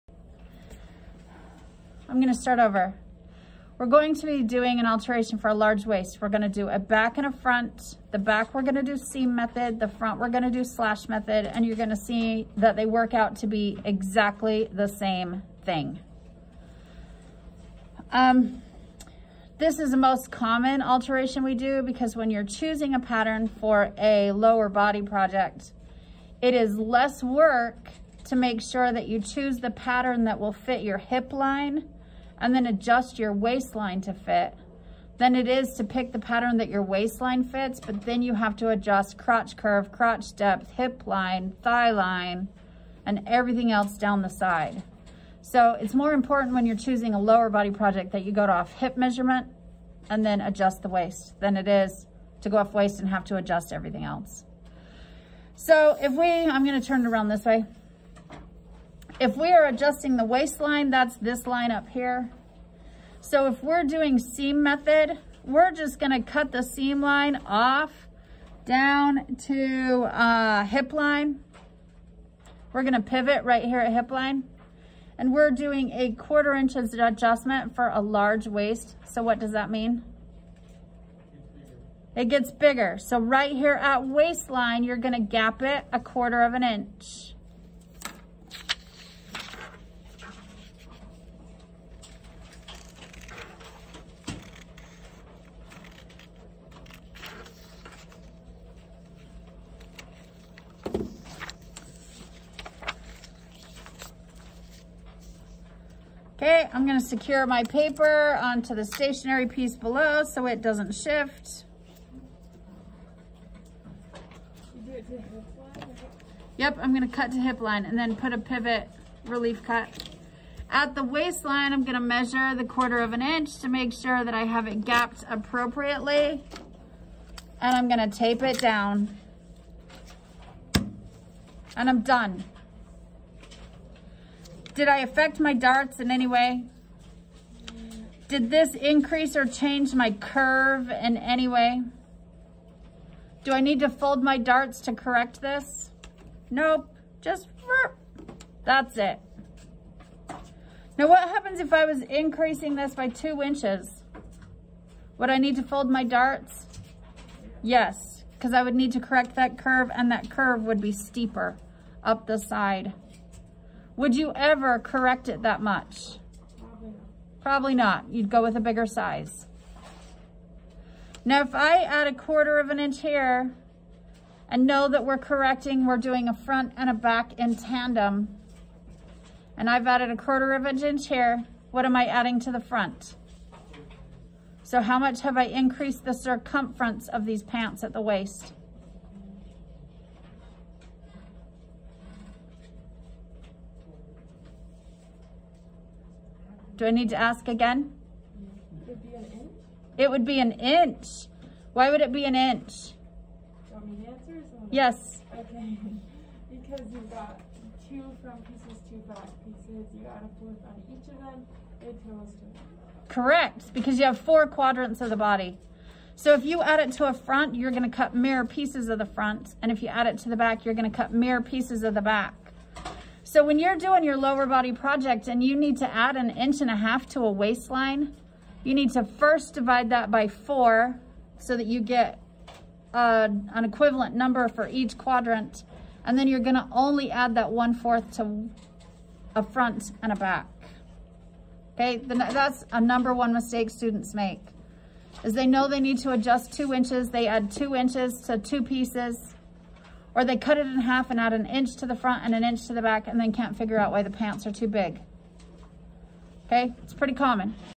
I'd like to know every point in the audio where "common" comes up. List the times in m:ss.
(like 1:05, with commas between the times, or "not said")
0:20, 4:17.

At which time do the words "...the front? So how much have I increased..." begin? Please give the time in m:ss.
3:02.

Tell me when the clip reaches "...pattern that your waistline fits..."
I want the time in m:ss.
0:36.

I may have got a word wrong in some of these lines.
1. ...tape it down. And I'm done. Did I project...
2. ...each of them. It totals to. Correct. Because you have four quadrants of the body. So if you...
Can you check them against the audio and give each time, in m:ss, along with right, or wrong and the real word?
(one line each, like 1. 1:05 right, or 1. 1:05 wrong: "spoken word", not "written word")
1. 2:08 wrong: "affect", not "project"
2. 3:30 right.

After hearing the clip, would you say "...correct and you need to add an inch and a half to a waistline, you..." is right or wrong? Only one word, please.
wrong.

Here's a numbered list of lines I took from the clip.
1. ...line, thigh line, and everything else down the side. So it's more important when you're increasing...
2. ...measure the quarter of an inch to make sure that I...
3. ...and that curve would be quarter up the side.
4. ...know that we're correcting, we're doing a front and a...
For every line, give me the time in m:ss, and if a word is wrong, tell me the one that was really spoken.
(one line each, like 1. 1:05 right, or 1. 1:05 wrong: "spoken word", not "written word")
1. 0:41 wrong: "choosing", not "increasing"
2. 2:01 right
3. 2:39 wrong: "steeper", not "quarter"
4. 2:54 right.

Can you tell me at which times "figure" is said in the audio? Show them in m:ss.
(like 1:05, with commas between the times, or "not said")
4:13.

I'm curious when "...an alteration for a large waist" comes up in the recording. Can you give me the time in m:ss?
0:04.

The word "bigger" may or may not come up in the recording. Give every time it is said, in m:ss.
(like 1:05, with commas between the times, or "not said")
1:22, 2:48.